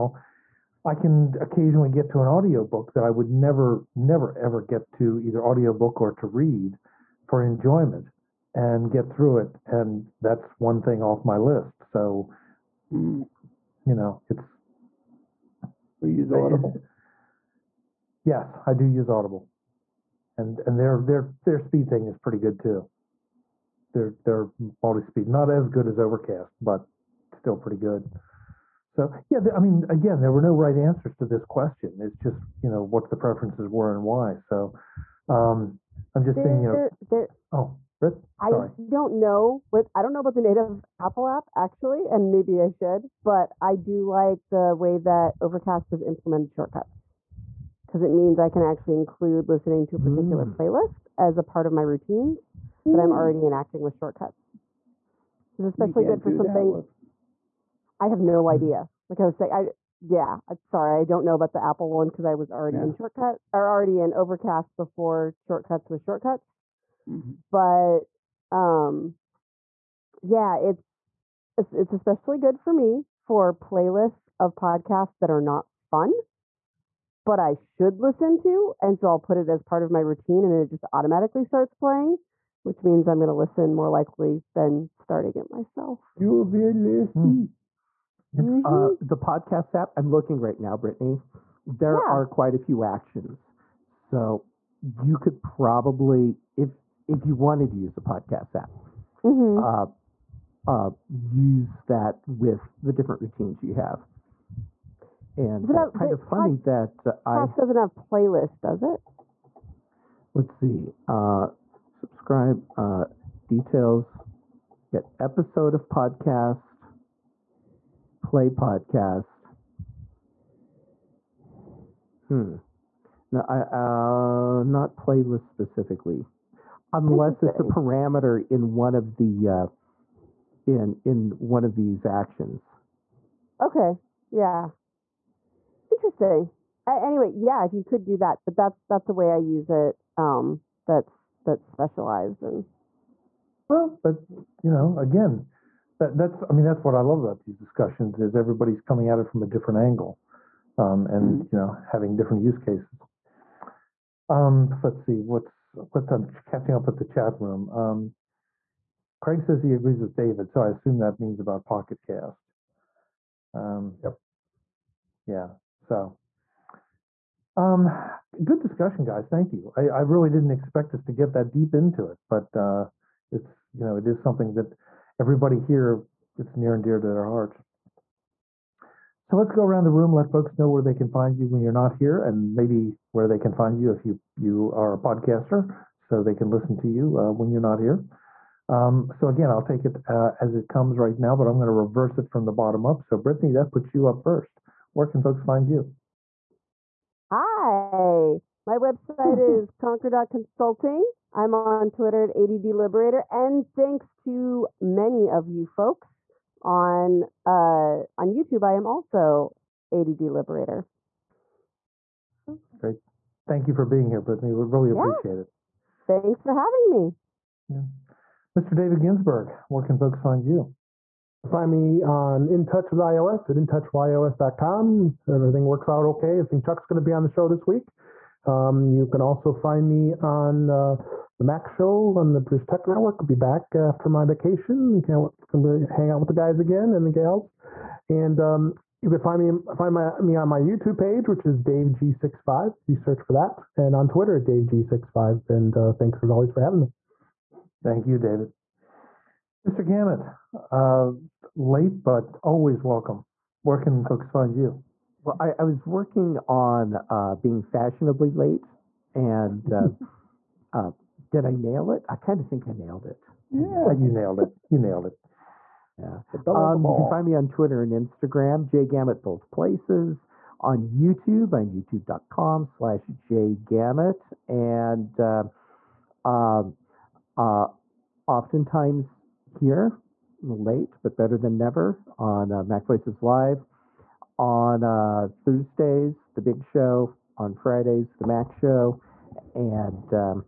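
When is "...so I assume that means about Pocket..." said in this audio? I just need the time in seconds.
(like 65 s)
160 s.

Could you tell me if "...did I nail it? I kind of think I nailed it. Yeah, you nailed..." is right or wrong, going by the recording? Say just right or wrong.
right.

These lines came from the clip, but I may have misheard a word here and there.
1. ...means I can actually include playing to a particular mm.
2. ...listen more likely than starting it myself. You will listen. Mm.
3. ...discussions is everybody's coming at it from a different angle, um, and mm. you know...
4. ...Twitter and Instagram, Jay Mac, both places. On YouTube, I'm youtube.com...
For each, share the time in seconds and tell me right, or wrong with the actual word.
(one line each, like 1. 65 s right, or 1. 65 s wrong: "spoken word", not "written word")
1. 48 s wrong: "listening", not "playing"
2. 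83 s right
3. 147 s right
4. 267 s wrong: "Gamet", not "Mac".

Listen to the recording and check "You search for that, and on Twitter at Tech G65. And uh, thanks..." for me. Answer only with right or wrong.
wrong.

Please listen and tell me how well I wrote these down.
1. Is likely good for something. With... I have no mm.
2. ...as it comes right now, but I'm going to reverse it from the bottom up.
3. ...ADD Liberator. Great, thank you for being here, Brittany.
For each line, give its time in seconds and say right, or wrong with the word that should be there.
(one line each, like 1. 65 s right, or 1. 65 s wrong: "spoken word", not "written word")
1. 55 s wrong: "especially", not "likely"
2. 190 s right
3. 209 s right.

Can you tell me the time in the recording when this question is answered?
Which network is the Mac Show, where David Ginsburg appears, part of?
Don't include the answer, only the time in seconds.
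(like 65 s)
232 s.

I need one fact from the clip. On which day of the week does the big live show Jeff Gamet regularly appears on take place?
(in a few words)
Thursdays.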